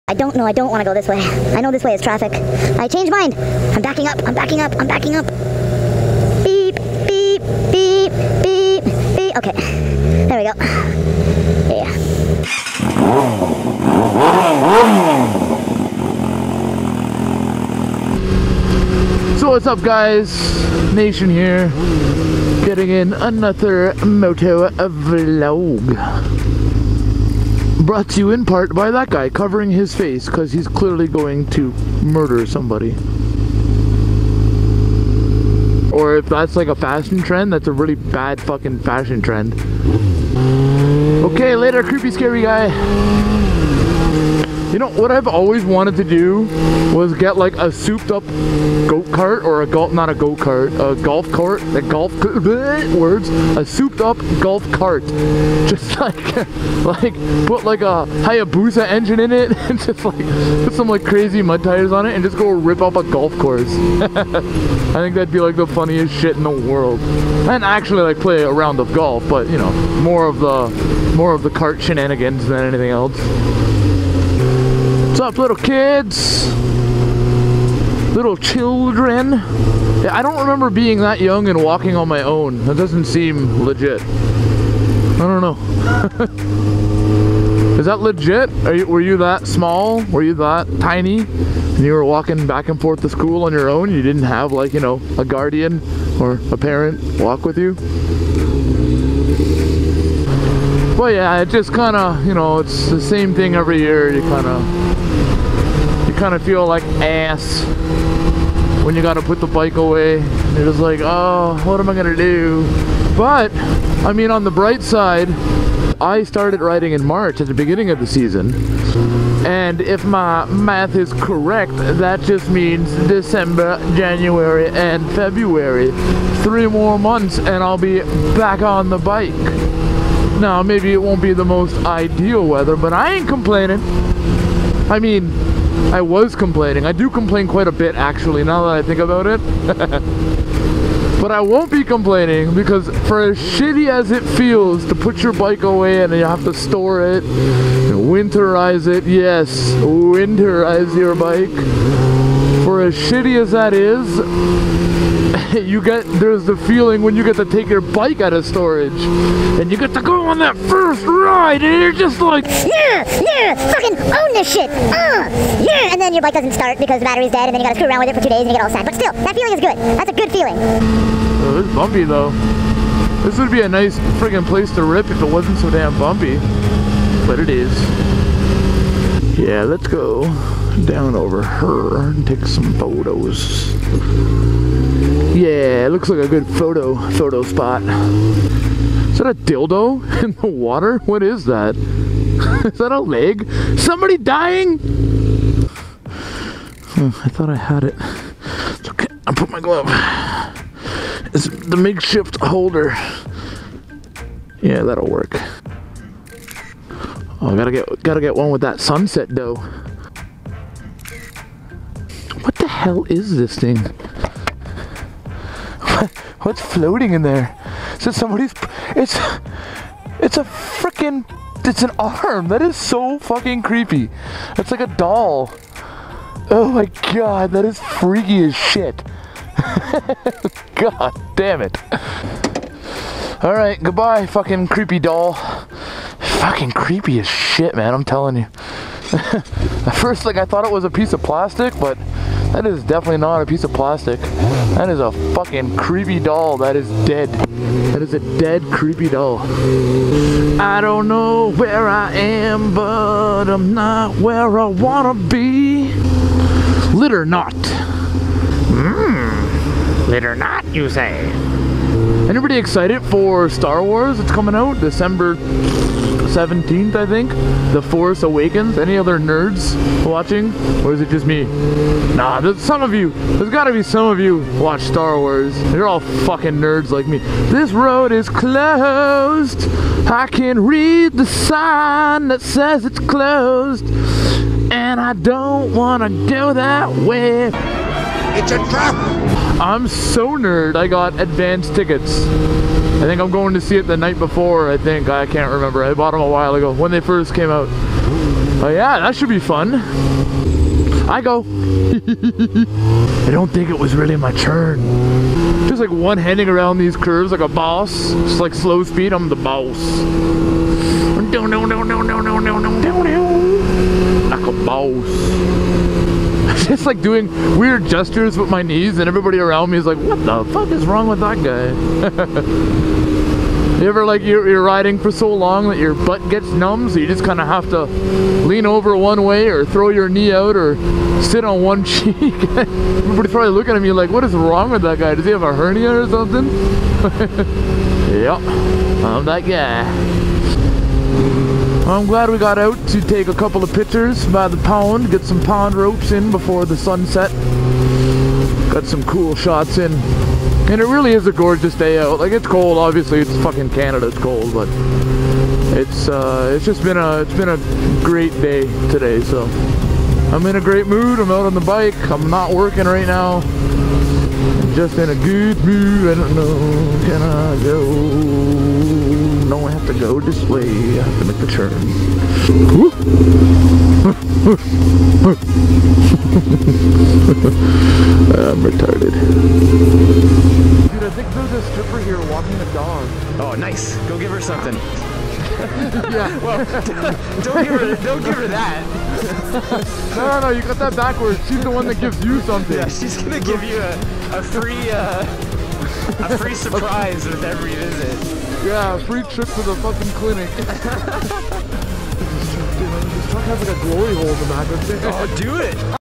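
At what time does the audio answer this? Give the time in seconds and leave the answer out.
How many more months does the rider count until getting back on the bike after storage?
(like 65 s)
126 s.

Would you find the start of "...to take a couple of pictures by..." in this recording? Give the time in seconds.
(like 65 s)
342 s.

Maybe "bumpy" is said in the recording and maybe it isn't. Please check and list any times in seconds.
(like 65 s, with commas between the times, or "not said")
171 s, 175 s.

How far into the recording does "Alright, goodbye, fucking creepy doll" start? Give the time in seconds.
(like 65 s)
233 s.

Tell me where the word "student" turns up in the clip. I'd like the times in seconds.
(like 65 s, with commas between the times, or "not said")
not said.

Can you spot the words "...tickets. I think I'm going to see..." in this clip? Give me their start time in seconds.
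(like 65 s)
291 s.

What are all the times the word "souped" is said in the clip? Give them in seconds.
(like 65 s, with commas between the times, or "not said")
47 s, 53 s.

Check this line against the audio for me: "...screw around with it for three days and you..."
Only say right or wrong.
wrong.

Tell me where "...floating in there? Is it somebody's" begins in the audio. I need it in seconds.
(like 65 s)
216 s.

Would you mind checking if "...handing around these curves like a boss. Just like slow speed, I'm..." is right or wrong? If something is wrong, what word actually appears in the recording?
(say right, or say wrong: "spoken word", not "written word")
right.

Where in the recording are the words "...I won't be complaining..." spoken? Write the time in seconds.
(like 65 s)
141 s.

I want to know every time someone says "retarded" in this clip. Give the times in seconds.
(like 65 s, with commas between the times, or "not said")
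378 s.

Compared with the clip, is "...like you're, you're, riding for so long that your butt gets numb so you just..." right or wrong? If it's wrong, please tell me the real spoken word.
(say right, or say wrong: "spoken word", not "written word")
right.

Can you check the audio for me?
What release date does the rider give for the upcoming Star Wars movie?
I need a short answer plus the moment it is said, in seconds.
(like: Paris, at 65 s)
December 17th, at 264 s.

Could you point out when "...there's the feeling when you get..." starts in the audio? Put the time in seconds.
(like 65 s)
156 s.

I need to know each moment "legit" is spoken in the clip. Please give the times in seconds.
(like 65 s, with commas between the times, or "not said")
83 s, 87 s.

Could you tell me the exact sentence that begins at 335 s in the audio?
Does he have a hernia or something?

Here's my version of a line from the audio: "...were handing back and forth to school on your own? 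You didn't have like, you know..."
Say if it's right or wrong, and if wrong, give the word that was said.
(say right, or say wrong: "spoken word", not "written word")
wrong: "walking", not "handing".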